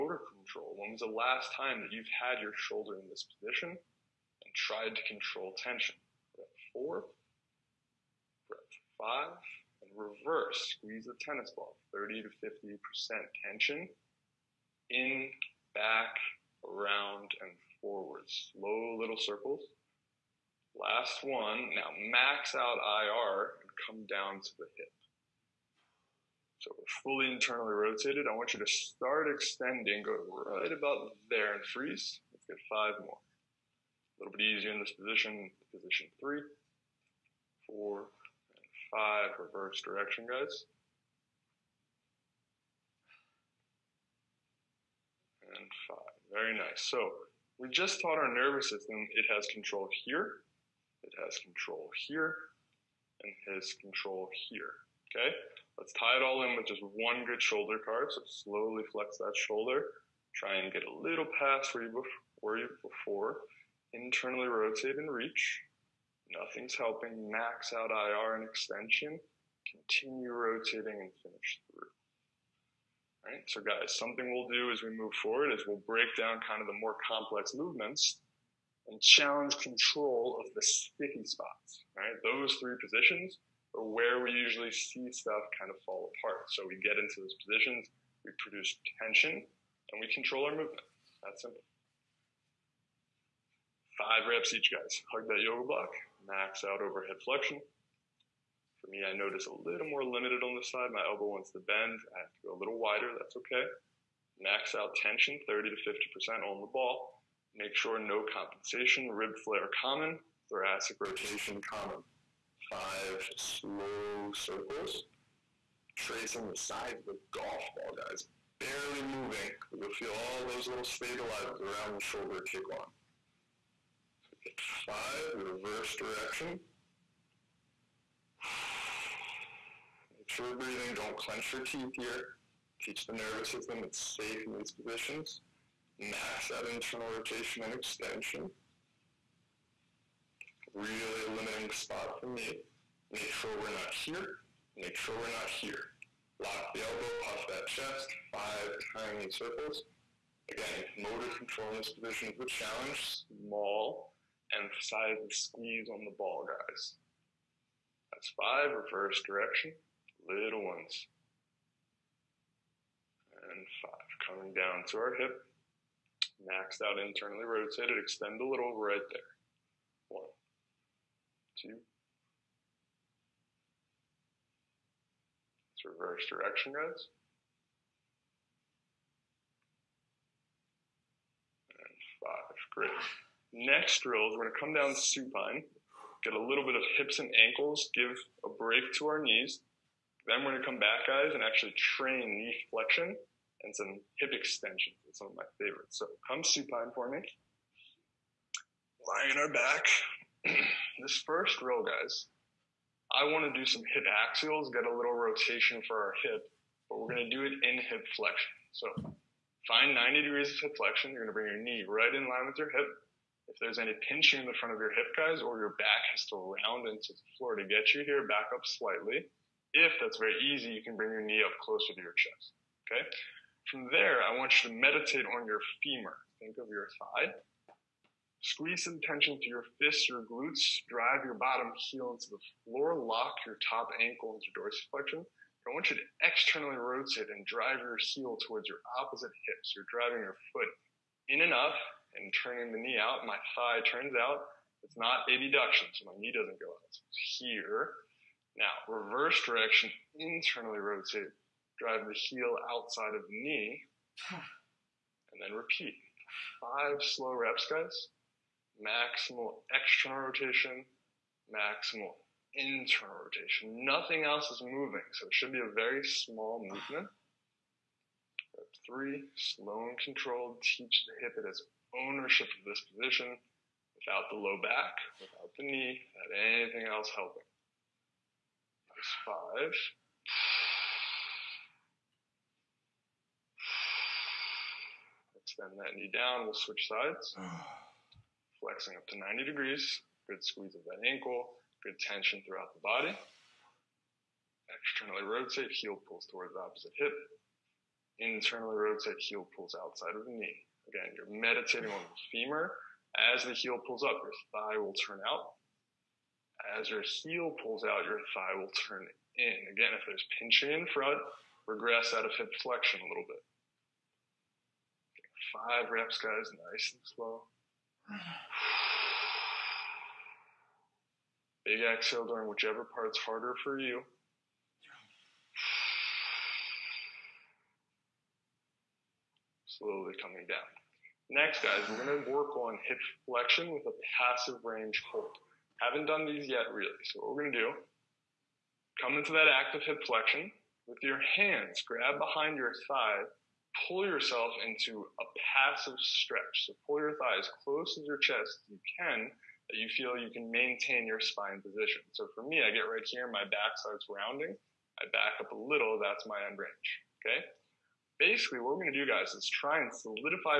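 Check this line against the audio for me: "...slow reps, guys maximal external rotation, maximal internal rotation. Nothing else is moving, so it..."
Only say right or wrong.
right.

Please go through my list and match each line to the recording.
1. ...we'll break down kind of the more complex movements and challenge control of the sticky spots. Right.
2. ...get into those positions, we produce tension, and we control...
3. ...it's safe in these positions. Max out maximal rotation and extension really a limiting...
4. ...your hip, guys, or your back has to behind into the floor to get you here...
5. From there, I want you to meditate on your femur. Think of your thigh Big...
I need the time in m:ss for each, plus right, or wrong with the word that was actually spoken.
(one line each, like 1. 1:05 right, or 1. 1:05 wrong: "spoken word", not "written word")
1. 1:15 right
2. 1:26 right
3. 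2:13 wrong: "internal", not "maximal"
4. 3:34 wrong: "round", not "behind"
5. 3:43 wrong: "Squeeze", not "Big".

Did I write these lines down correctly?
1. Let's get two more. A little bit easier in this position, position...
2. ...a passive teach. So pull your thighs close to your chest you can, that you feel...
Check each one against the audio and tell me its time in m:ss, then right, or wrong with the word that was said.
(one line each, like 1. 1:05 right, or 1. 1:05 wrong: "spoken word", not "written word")
1. 0:32 wrong: "five", not "two"
2. 5:45 wrong: "stretch", not "teach".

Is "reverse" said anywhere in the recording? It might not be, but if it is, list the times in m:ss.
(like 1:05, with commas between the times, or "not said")
0:09, 0:39, 2:05, 2:38, 2:55, 4:08.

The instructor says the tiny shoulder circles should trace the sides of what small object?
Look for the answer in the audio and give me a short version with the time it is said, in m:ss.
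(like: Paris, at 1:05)
golf ball, at 1:57.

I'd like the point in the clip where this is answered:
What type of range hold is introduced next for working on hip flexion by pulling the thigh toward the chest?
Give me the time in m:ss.
5:34.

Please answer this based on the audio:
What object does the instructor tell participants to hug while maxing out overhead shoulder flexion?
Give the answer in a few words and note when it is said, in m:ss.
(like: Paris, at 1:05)
yoga block, at 1:35.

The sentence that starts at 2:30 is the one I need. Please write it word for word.
Again, motor control in this position is the challenge.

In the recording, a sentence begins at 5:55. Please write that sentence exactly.
I back up a little, that's my end range.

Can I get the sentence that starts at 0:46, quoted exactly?
So we just taught our nervous system it has control here, it has control here, and has control here, okay?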